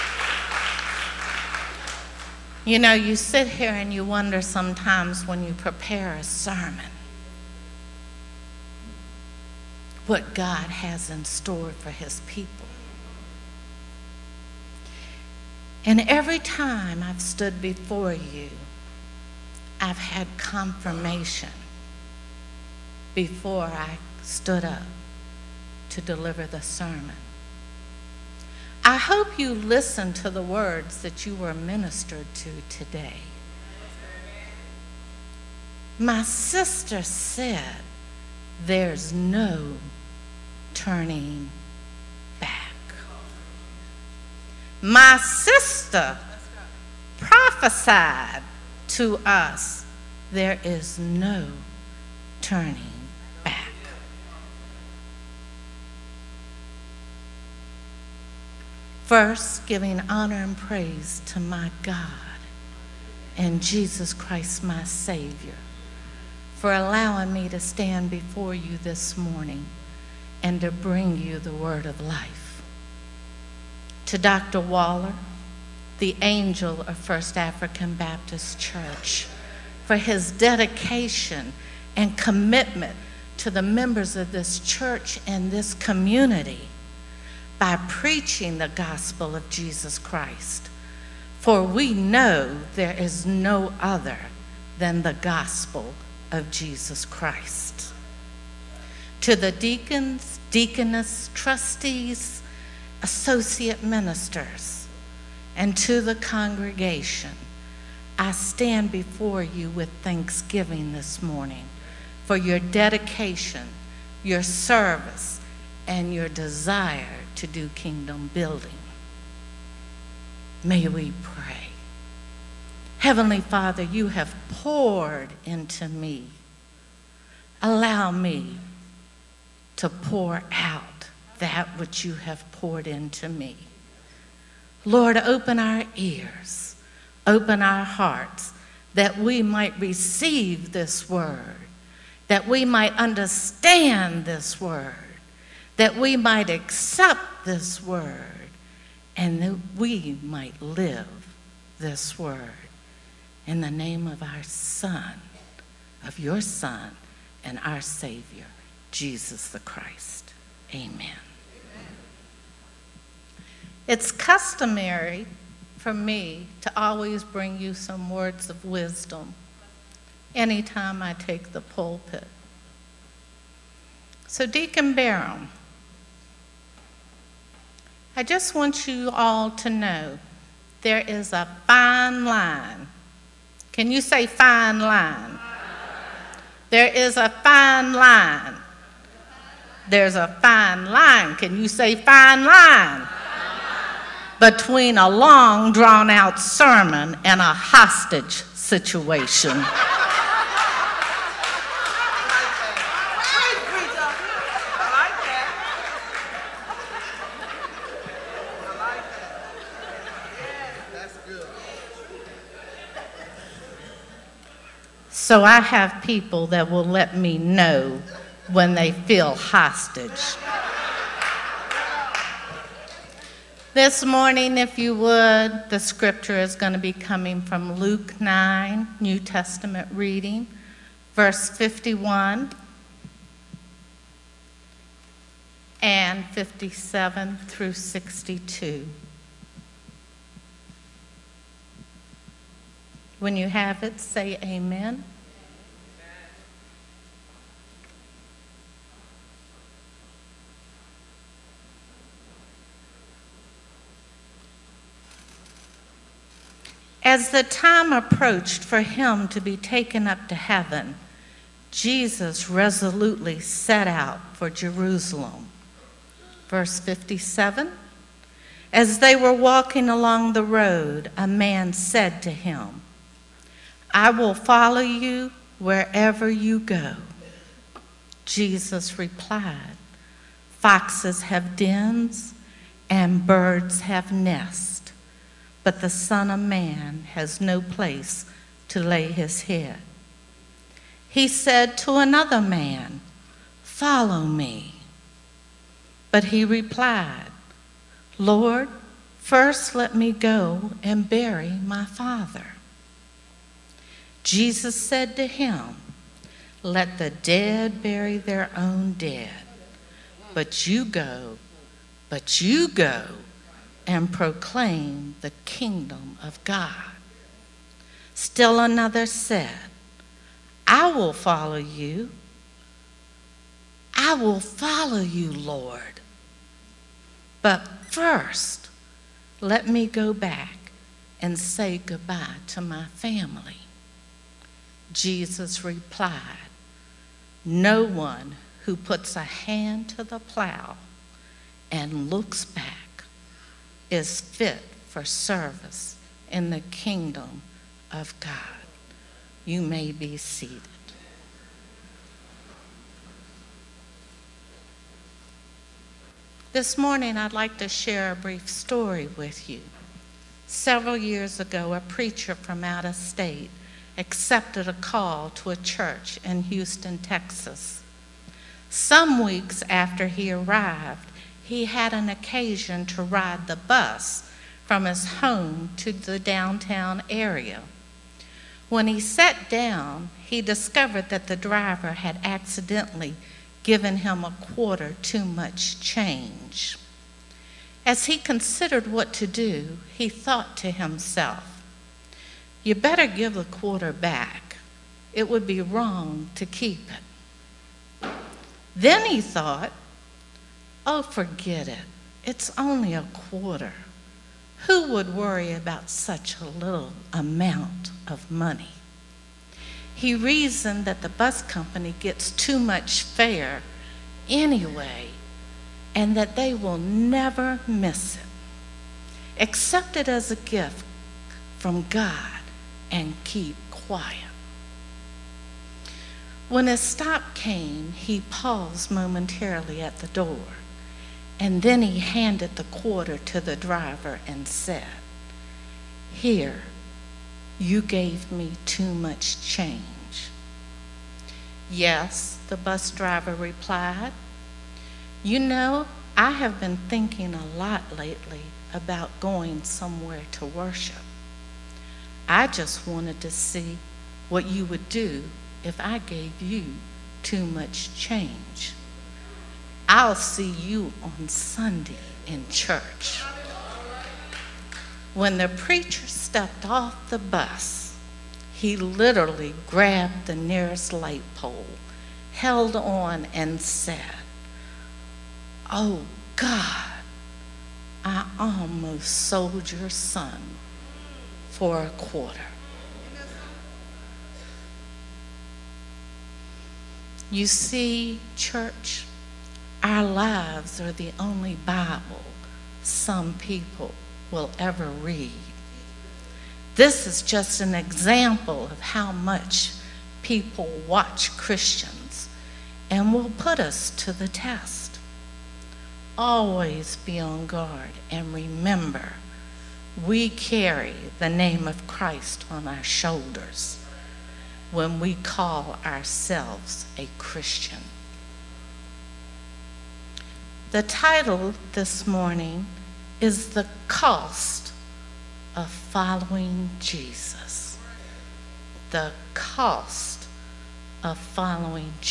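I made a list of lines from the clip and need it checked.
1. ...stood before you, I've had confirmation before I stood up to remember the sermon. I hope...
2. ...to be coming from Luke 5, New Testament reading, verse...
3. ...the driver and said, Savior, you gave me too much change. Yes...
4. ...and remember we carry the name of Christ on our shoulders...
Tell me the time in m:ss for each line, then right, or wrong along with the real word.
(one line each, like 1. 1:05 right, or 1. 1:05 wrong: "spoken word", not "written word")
1. 0:17 wrong: "deliver", not "remember"
2. 3:46 wrong: "9", not "5"
3. 7:13 wrong: "Here", not "Savior"
4. 8:28 right.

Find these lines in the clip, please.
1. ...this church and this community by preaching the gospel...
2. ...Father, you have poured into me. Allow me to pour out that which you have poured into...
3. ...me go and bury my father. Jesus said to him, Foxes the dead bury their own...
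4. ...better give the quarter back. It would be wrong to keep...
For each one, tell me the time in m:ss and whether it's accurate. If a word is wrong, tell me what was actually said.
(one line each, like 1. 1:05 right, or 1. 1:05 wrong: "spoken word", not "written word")
1. 1:24 right
2. 2:03 right
3. 4:59 wrong: "Let", not "Foxes"
4. 6:32 right.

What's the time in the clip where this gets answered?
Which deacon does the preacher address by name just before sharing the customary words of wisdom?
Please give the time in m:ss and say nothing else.
2:54.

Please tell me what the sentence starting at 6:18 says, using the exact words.
When he sat down, he discovered that the driver had accidentally given him a quarter too much change.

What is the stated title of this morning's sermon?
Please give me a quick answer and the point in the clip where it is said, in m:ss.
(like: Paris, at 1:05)
The Cost of Following Jesus, at 8:43.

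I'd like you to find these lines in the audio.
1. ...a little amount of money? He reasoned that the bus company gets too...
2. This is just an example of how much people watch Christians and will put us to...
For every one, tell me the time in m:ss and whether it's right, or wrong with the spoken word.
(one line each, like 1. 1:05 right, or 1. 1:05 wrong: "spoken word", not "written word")
1. 6:46 right
2. 8:16 right.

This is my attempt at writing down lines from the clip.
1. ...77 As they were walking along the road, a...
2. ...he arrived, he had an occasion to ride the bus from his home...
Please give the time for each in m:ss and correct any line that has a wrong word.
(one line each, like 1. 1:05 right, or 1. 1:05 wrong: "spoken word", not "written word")
1. 4:26 wrong: "57", not "77"
2. 6:10 right.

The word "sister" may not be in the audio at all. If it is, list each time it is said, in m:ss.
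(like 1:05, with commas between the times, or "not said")
0:36, 0:45.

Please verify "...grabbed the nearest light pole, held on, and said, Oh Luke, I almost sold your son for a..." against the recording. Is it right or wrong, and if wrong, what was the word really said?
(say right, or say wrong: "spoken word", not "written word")
wrong: "God", not "Luke".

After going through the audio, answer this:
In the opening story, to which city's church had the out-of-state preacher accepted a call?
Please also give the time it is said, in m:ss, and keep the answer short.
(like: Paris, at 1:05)
Houston, Texas, at 6:06.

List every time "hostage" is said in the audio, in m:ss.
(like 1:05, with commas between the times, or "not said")
3:17, 3:39.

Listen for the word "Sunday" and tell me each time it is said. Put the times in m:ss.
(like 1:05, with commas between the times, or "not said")
7:41.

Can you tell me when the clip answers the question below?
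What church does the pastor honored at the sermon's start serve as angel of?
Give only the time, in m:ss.
1:16.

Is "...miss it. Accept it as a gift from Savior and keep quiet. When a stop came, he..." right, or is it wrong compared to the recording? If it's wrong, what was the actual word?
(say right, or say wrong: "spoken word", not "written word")
wrong: "God", not "Savior".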